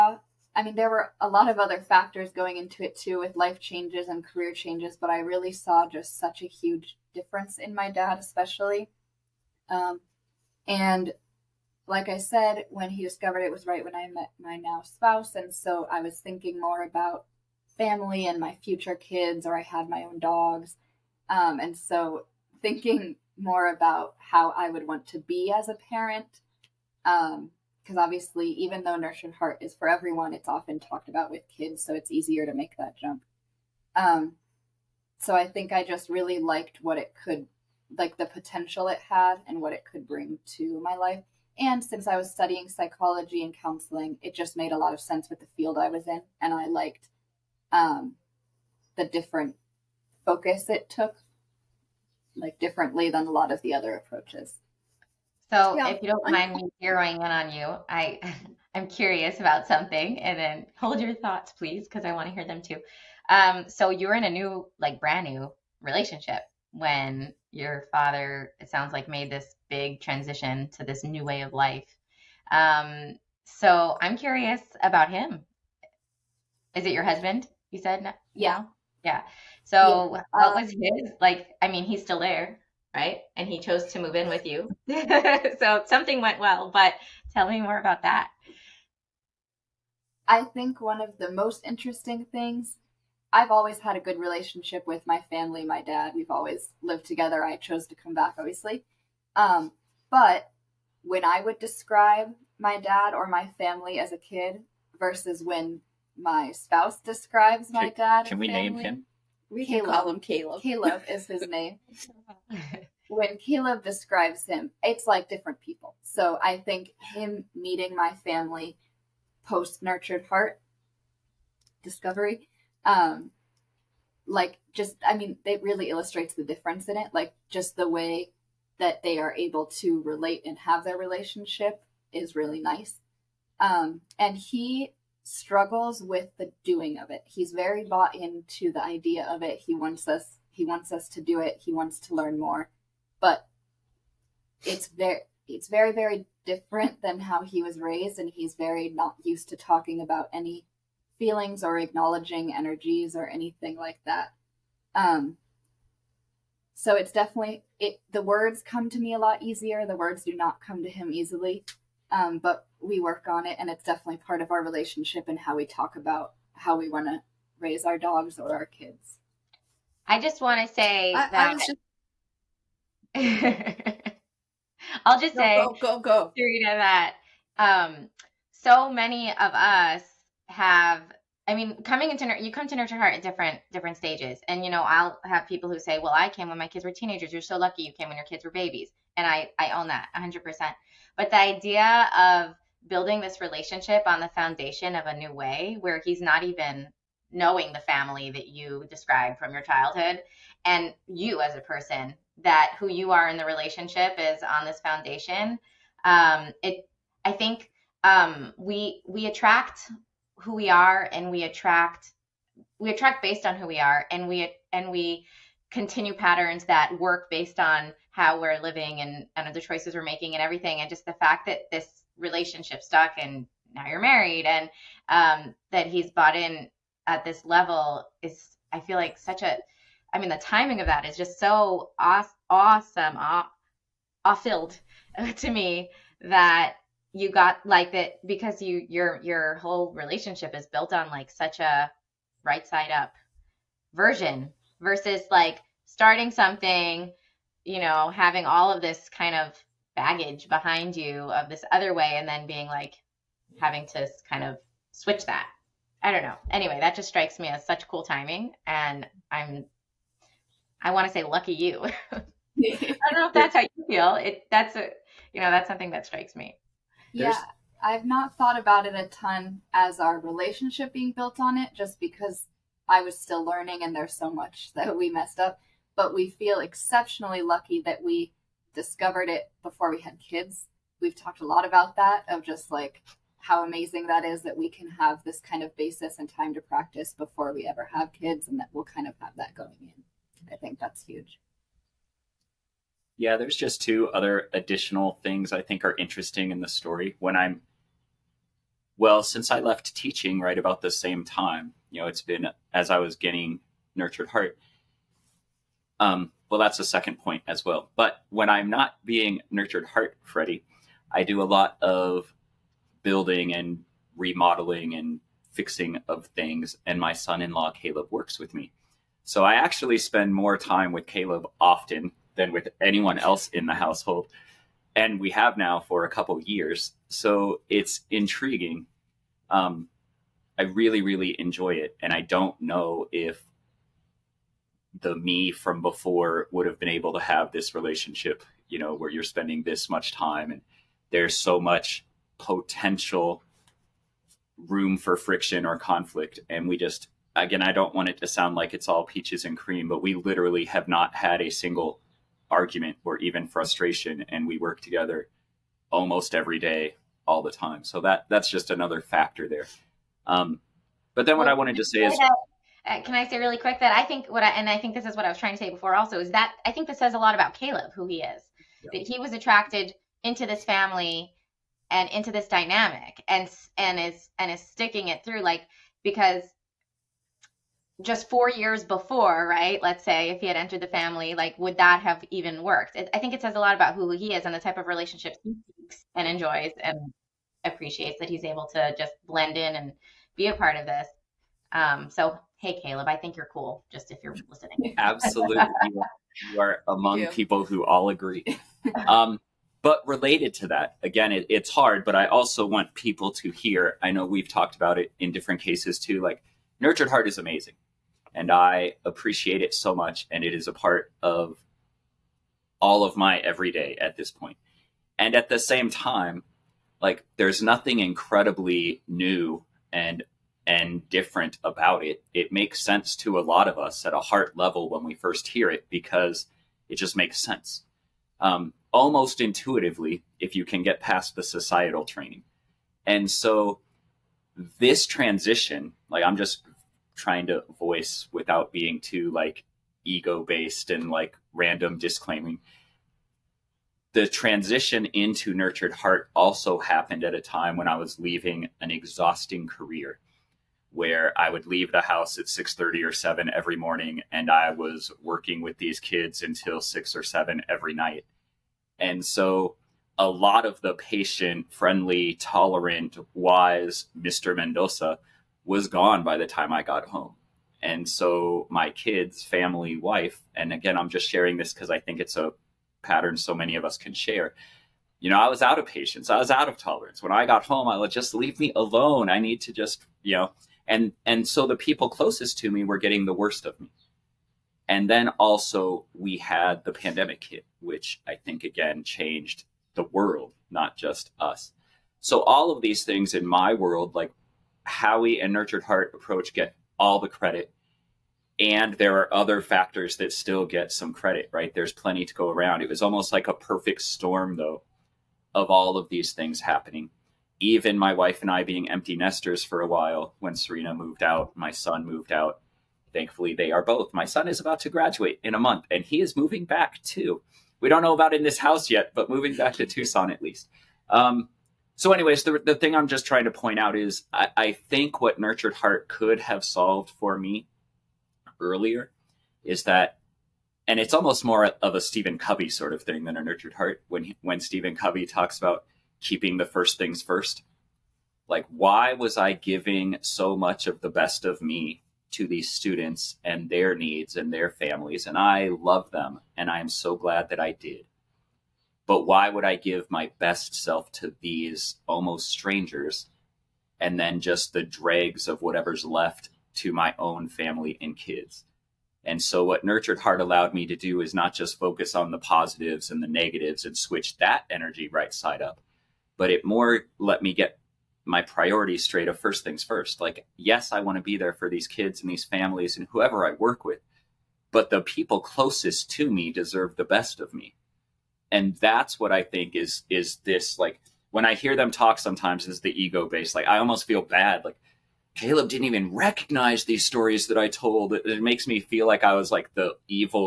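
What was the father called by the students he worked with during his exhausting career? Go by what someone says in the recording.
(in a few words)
Mr. Mendoza.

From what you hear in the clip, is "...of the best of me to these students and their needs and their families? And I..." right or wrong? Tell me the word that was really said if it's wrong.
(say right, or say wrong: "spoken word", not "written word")
right.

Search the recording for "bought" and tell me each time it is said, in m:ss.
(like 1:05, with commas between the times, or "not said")
2:17, 3:46.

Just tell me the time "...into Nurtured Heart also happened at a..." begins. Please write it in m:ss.
7:25.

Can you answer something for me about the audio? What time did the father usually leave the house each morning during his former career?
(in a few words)
6:30.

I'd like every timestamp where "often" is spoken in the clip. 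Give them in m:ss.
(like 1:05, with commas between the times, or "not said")
0:30, 5:21.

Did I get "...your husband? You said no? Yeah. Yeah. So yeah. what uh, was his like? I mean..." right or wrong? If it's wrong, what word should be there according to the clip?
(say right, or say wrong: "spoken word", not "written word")
right.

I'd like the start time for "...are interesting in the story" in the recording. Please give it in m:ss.
4:55.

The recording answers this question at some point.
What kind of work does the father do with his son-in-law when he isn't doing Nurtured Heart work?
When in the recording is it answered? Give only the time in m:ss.
5:13.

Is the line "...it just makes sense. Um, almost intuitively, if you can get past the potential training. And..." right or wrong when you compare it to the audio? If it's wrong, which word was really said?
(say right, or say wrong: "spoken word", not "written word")
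wrong: "societal", not "potential".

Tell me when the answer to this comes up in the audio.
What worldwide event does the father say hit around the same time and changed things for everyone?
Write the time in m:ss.
8:06.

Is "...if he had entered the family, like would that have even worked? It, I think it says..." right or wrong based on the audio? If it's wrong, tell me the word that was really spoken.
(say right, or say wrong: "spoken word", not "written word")
right.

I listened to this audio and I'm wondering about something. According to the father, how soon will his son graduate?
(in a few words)
in a month.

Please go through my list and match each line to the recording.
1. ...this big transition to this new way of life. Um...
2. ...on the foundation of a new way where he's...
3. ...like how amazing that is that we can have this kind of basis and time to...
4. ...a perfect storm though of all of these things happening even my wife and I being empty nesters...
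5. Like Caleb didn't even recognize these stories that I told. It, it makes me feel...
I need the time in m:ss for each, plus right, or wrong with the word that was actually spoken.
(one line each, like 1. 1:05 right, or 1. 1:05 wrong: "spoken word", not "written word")
1. 1:09 right
2. 3:14 right
3. 4:42 right
4. 8:23 right
5. 9:44 right.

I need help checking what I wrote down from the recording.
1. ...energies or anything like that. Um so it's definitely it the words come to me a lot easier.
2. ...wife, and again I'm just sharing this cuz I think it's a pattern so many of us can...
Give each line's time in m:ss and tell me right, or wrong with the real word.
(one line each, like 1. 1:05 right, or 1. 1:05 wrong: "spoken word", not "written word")
1. 2:32 right
2. 7:49 right.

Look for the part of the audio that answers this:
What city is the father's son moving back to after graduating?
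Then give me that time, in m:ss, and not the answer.
8:39.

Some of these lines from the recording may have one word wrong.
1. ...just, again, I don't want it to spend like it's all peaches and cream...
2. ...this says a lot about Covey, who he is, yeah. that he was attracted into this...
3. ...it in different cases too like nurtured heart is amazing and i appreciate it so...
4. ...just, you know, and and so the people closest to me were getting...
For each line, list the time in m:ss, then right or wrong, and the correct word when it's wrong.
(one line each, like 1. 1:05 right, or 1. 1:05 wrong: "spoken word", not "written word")
1. 5:46 wrong: "sound", not "spend"
2. 6:06 wrong: "Caleb", not "Covey"
3. 6:44 right
4. 7:59 right.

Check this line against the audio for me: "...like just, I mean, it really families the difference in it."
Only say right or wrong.
wrong.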